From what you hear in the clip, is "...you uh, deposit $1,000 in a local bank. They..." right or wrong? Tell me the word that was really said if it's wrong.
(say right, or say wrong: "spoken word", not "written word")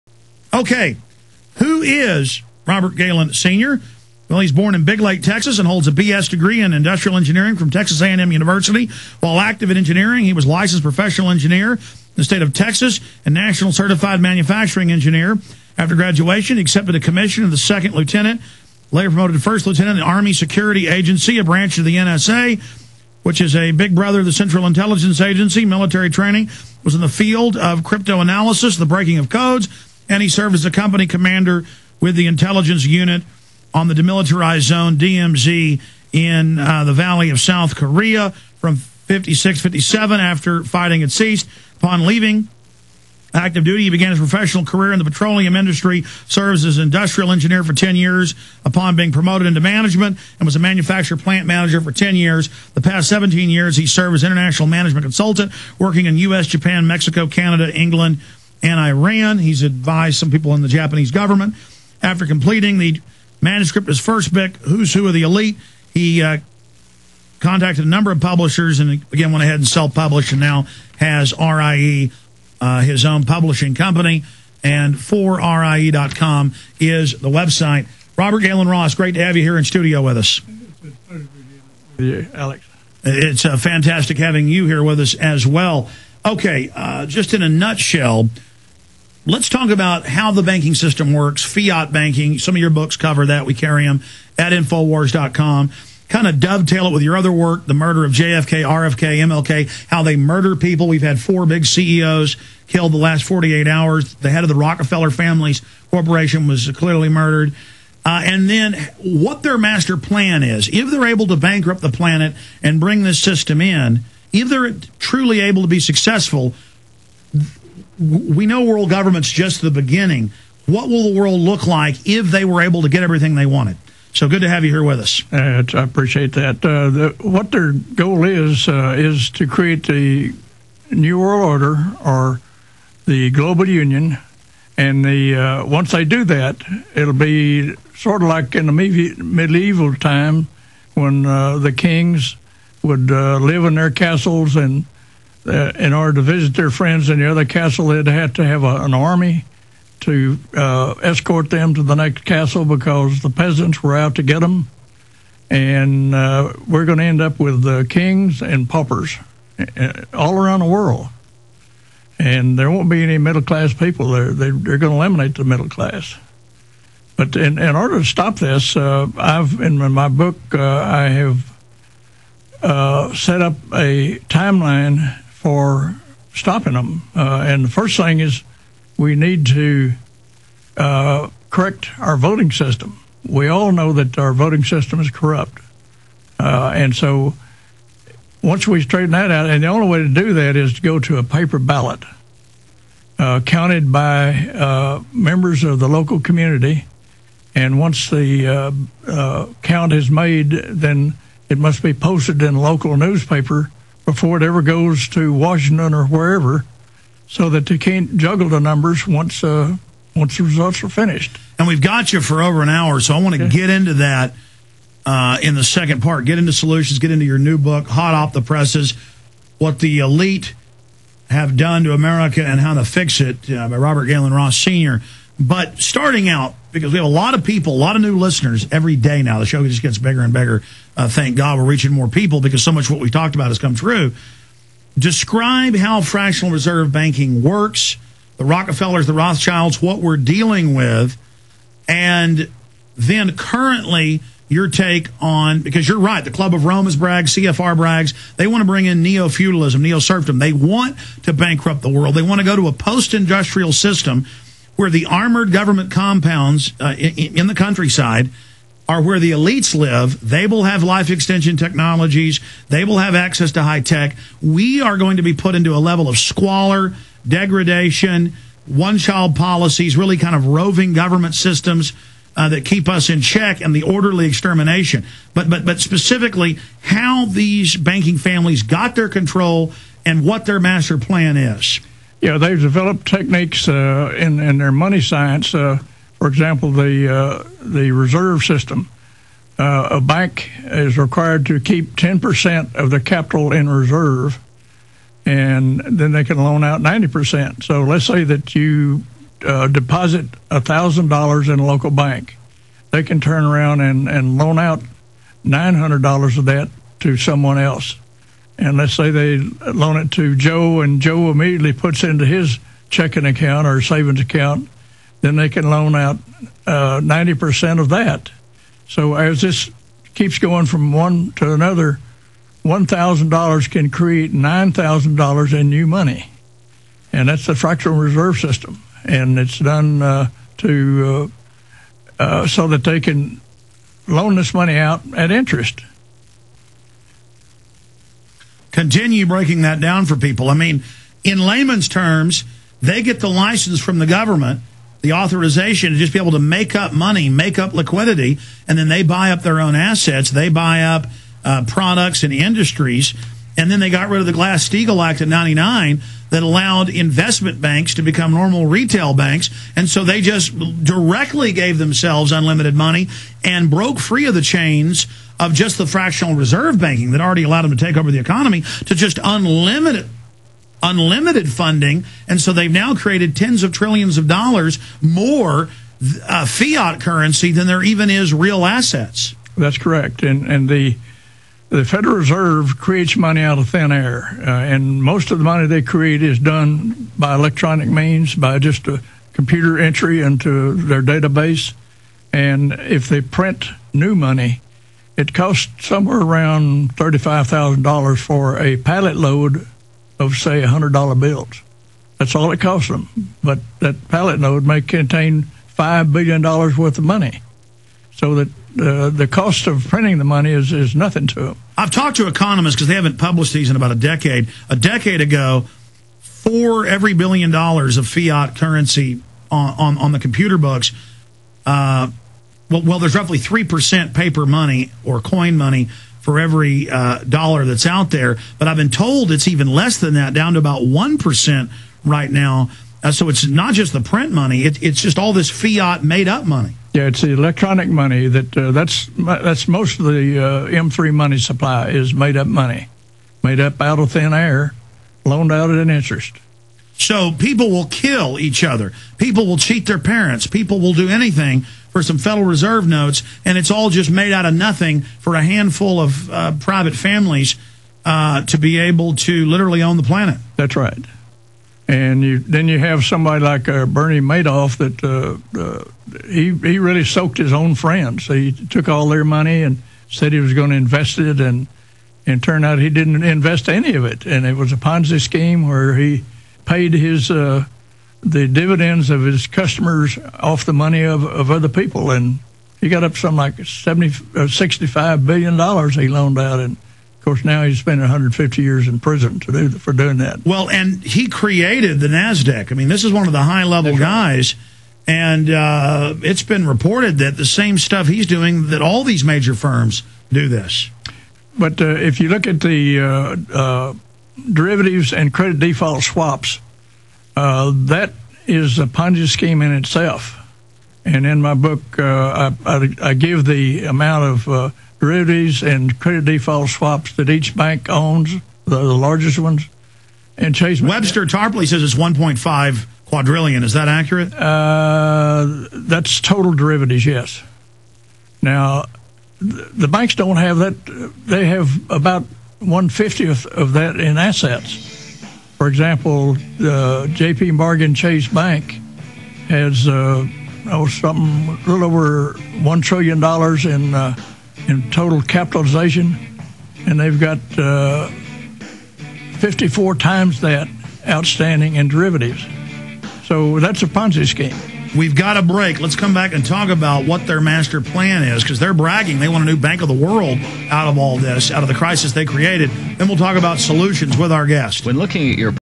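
right.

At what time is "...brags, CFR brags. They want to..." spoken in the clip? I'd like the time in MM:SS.
04:06.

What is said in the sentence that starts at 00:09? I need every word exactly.
While active in engineering, he was licensed professional engineer in the state of Texas and national certified manufacturing engineer.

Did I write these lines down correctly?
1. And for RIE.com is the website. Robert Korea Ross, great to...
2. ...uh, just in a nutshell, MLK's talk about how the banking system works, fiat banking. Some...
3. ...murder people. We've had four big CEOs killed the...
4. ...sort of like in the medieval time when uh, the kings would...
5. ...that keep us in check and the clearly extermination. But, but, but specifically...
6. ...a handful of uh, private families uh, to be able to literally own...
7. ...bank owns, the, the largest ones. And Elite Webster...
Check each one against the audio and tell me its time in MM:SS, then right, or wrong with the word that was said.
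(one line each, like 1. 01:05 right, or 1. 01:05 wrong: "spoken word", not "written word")
1. 01:14 wrong: "Gaylon", not "Korea"
2. 01:26 wrong: "Let", not "MLK"
3. 01:40 right
4. 02:17 right
5. 04:32 wrong: "orderly", not "clearly"
6. 07:35 right
7. 08:37 wrong: "Chase", not "Elite".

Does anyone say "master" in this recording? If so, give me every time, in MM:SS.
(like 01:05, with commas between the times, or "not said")
01:49, 04:40, 09:17.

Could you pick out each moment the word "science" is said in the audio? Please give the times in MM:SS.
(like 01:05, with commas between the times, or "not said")
04:45.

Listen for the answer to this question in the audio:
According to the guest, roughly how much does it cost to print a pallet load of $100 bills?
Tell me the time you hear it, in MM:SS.
06:36.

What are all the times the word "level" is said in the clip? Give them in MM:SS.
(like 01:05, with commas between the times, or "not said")
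04:25, 08:13.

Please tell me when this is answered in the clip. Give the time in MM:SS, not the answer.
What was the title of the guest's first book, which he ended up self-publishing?
01:04.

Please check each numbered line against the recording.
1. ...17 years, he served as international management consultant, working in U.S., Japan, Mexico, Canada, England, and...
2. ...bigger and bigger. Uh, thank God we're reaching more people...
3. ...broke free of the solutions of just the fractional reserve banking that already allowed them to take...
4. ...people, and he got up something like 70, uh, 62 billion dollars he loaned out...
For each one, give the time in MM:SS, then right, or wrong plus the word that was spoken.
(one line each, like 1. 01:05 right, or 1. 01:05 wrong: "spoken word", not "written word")
1. 00:53 right
2. 03:49 right
3. 06:03 wrong: "chains", not "solutions"
4. 08:01 wrong: "65", not "62".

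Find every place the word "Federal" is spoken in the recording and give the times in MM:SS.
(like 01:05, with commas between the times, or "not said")
06:21, 07:32.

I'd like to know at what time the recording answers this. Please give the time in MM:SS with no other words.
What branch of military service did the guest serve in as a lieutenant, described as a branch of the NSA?
00:20.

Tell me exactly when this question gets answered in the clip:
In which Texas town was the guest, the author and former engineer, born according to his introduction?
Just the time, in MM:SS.
00:04.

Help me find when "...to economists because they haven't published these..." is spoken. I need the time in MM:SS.
06:52.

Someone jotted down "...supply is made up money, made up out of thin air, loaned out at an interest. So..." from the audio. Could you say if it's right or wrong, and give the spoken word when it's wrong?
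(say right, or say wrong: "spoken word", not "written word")
right.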